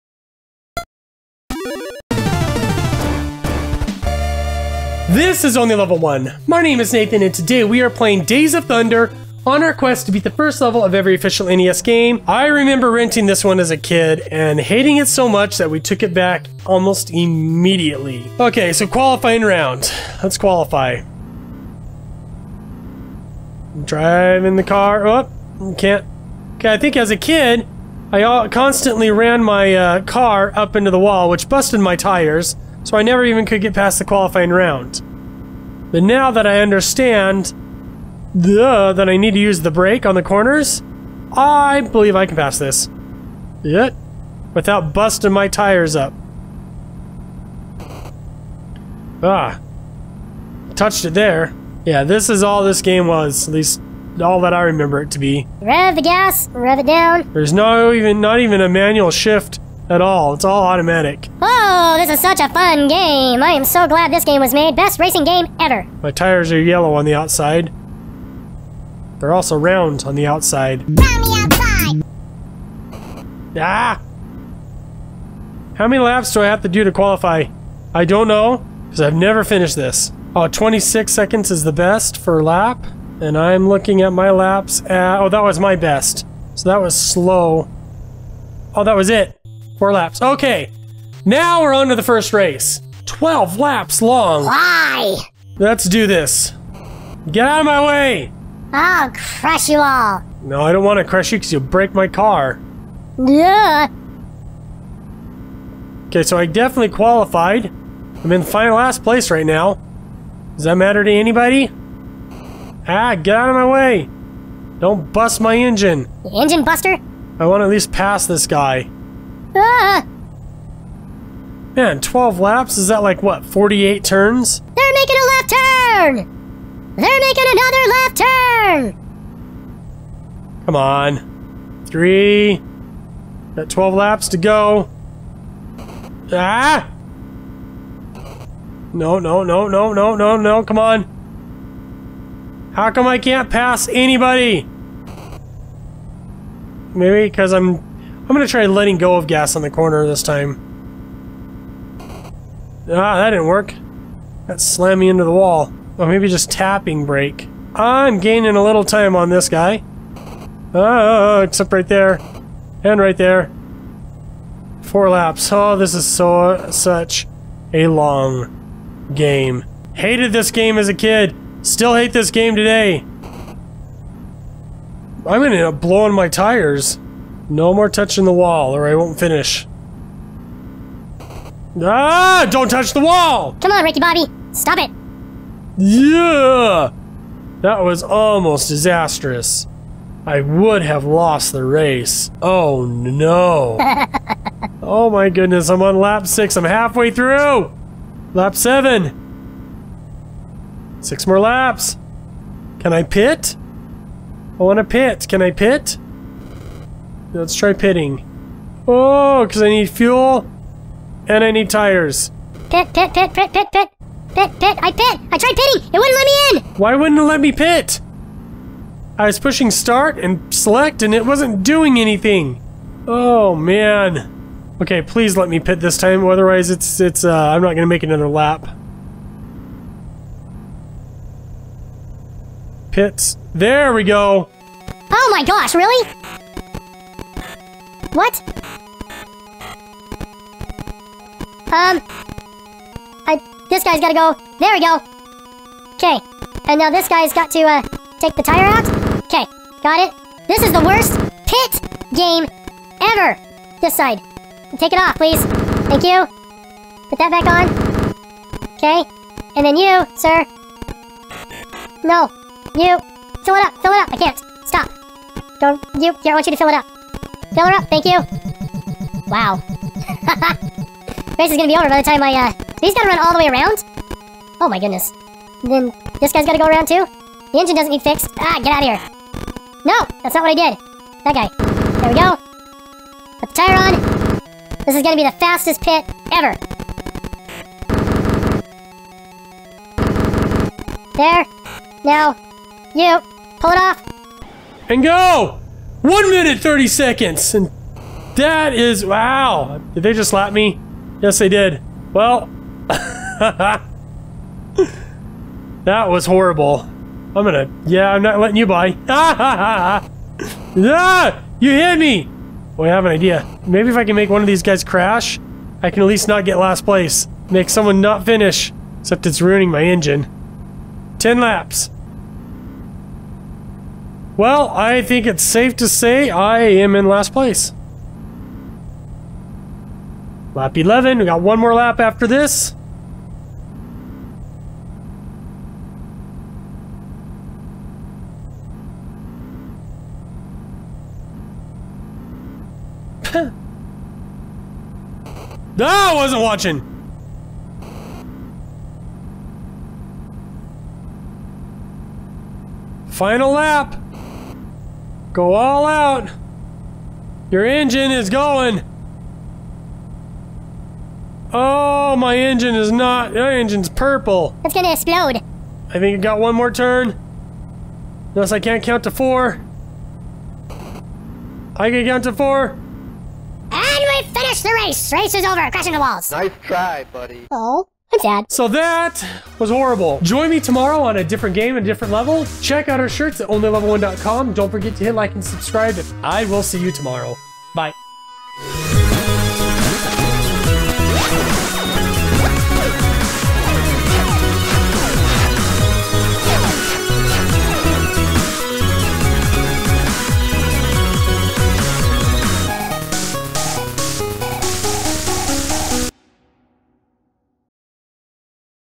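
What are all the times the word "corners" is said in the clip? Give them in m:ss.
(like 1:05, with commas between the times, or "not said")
0:40, 2:29.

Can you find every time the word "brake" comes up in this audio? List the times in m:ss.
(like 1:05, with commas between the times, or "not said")
0:39, 2:37.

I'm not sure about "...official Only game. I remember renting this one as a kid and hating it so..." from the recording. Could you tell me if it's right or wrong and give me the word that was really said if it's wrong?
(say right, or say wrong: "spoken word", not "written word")
wrong: "NES", not "Only".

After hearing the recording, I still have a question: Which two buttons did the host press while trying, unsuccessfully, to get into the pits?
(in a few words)
start and select.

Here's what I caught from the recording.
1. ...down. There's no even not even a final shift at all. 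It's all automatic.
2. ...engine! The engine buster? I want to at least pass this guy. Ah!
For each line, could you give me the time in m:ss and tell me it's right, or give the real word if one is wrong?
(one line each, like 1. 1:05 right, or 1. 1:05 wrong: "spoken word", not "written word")
1. 0:56 wrong: "manual", not "final"
2. 1:55 right.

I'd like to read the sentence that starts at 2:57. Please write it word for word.
No more touching the wall or I won't finish.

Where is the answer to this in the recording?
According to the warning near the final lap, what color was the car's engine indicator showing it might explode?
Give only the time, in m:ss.
6:03.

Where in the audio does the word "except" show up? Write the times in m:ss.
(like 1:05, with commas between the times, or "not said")
2:41, 5:18.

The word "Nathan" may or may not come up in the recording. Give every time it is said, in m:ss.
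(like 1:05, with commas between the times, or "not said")
0:06.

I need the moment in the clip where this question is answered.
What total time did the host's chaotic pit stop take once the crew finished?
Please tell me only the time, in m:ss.
4:56.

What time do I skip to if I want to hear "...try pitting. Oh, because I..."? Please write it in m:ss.
3:27.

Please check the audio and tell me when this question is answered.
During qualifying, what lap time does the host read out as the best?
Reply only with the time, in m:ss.
1:20.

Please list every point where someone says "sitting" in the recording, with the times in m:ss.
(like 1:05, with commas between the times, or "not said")
not said.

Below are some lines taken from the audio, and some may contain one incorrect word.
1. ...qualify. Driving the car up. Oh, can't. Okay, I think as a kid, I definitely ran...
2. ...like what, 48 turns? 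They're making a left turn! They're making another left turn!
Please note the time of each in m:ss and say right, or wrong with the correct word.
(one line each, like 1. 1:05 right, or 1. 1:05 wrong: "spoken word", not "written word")
1. 0:20 wrong: "constantly", not "definitely"
2. 2:03 right.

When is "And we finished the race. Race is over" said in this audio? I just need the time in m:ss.
6:12.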